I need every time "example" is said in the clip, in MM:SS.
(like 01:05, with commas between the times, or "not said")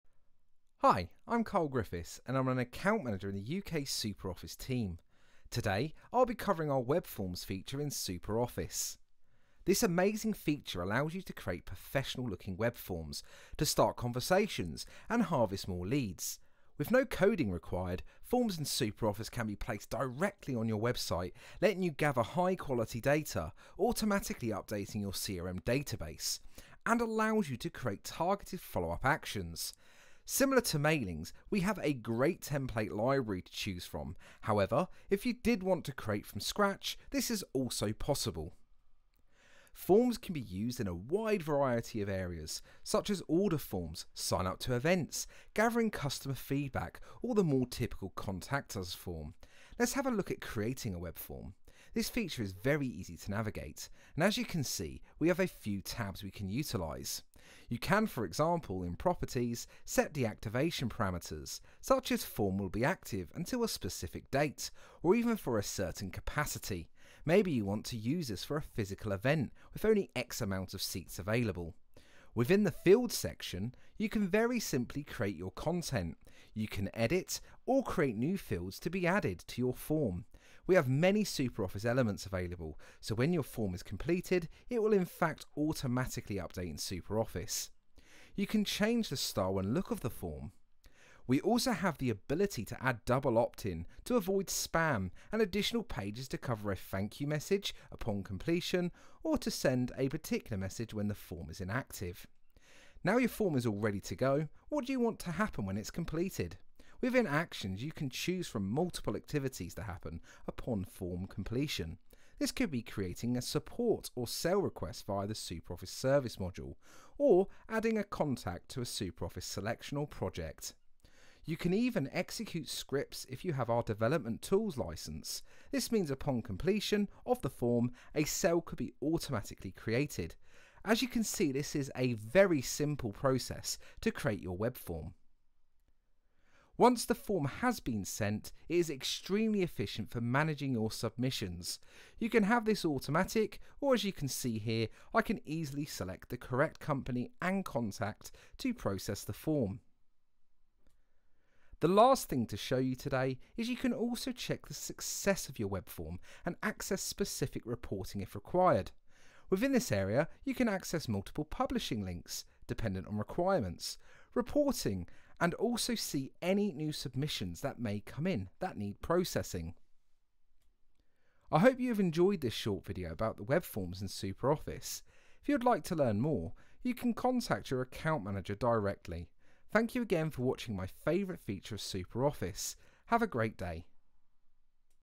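00:58.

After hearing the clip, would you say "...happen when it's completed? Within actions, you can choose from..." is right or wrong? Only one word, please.
right.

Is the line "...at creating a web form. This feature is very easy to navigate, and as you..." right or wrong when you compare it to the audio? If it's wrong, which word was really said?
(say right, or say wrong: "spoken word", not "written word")
right.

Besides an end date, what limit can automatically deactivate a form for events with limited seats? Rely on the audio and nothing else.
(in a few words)
Capacity.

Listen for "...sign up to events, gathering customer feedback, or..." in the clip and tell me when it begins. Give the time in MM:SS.
00:44.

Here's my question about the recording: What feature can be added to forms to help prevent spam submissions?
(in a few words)
Double opt-in.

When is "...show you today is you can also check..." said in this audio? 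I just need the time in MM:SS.
02:32.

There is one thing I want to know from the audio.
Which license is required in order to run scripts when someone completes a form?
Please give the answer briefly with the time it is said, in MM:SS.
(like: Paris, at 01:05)
Development tools license, at 02:03.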